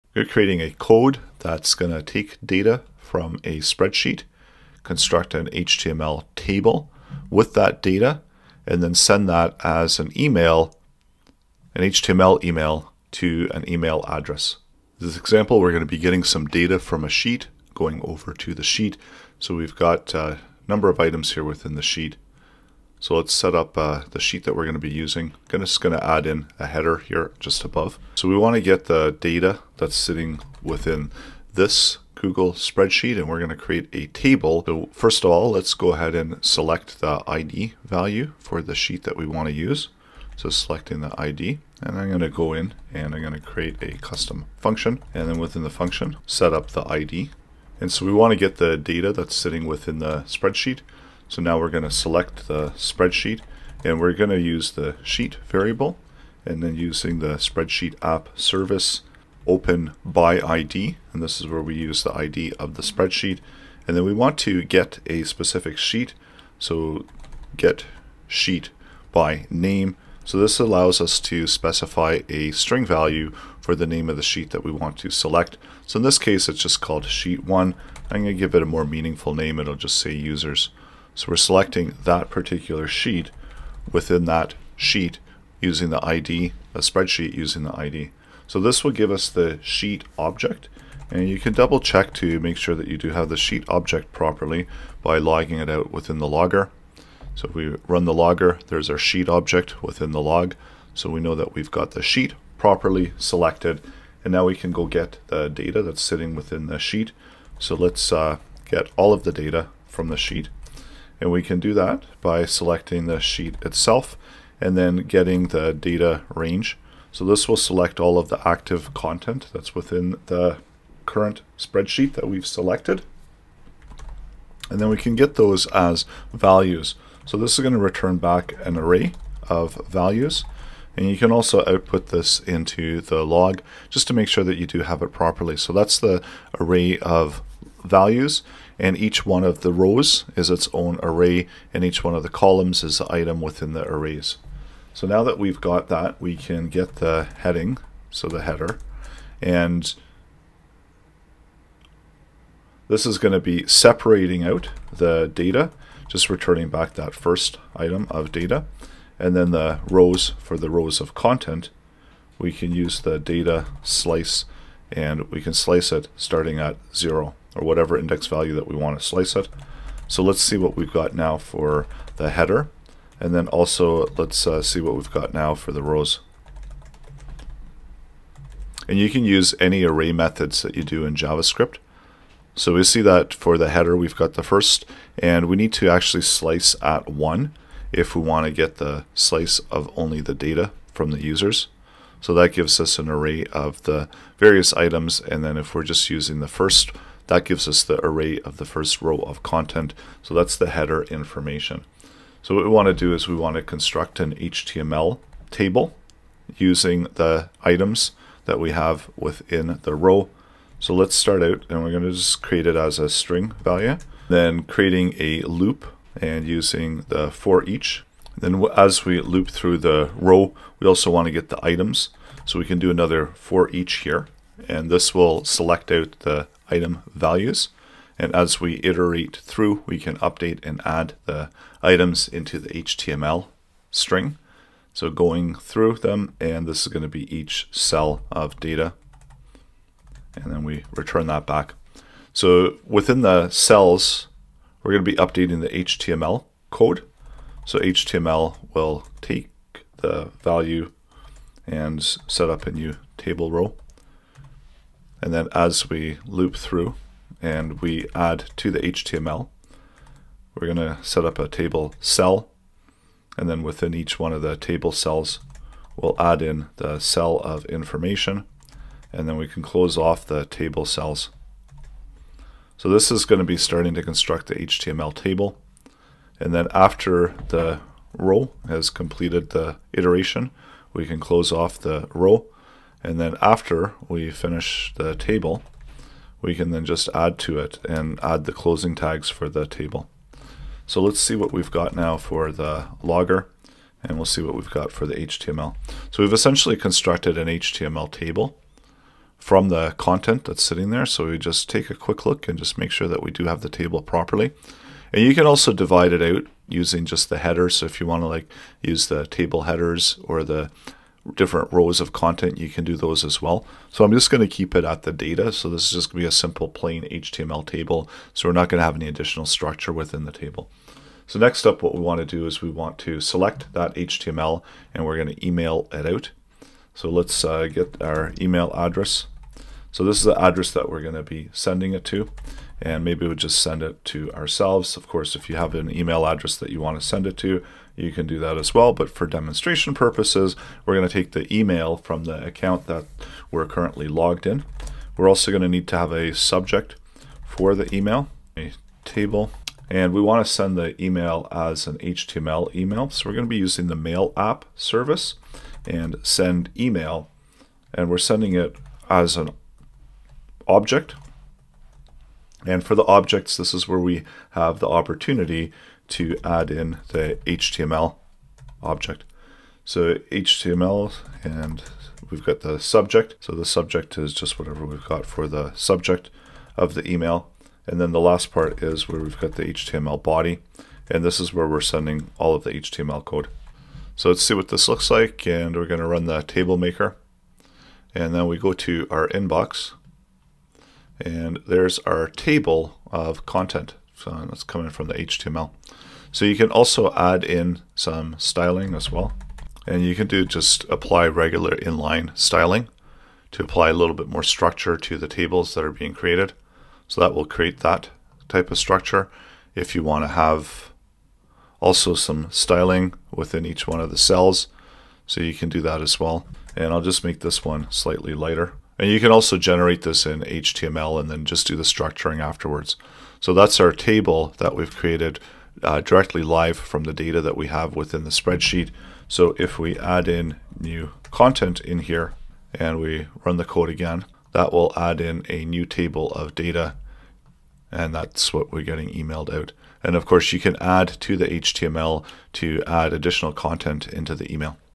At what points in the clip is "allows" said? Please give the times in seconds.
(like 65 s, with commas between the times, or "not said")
70 s.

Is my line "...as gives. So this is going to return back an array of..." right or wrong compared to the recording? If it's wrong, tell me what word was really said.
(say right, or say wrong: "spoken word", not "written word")
wrong: "values", not "gives".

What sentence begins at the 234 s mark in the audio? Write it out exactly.
So going through them, and this is going to be each cell of data.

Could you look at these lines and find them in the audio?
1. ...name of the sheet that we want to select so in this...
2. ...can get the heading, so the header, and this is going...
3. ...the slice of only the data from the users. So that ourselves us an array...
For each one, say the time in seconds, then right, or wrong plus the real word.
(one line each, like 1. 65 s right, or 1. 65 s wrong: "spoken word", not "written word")
1. 73 s right
2. 146 s right
3. 188 s wrong: "gives", not "ourselves".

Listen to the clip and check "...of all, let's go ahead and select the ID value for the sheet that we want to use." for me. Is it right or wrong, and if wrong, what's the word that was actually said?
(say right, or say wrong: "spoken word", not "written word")
right.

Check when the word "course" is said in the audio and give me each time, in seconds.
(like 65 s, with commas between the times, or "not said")
335 s, 440 s.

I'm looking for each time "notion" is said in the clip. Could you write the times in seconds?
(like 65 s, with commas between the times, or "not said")
not said.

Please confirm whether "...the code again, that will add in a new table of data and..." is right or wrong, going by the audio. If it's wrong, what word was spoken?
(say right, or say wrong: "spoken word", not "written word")
right.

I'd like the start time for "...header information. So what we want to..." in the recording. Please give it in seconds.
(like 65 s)
200 s.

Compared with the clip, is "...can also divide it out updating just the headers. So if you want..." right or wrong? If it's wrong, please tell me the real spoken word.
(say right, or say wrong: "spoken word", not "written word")
wrong: "using", not "updating".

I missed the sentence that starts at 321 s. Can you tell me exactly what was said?
So next up, what we want to do is we want to select that HTML and we're going to email it out.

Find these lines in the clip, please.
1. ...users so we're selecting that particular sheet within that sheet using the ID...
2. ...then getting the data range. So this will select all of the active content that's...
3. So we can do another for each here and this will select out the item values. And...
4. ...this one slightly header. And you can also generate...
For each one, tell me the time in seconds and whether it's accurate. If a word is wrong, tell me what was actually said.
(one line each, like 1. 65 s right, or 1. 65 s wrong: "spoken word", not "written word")
1. 80 s right
2. 114 s right
3. 222 s right
4. 417 s wrong: "lighter", not "header".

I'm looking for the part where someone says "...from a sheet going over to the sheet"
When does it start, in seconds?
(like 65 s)
16 s.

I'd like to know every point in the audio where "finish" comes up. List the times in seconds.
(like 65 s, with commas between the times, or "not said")
284 s.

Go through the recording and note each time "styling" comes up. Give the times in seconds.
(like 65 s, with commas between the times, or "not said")
398 s, 402 s, 412 s.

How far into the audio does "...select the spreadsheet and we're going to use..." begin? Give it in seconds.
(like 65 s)
51 s.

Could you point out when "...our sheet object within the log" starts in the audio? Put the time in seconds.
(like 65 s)
98 s.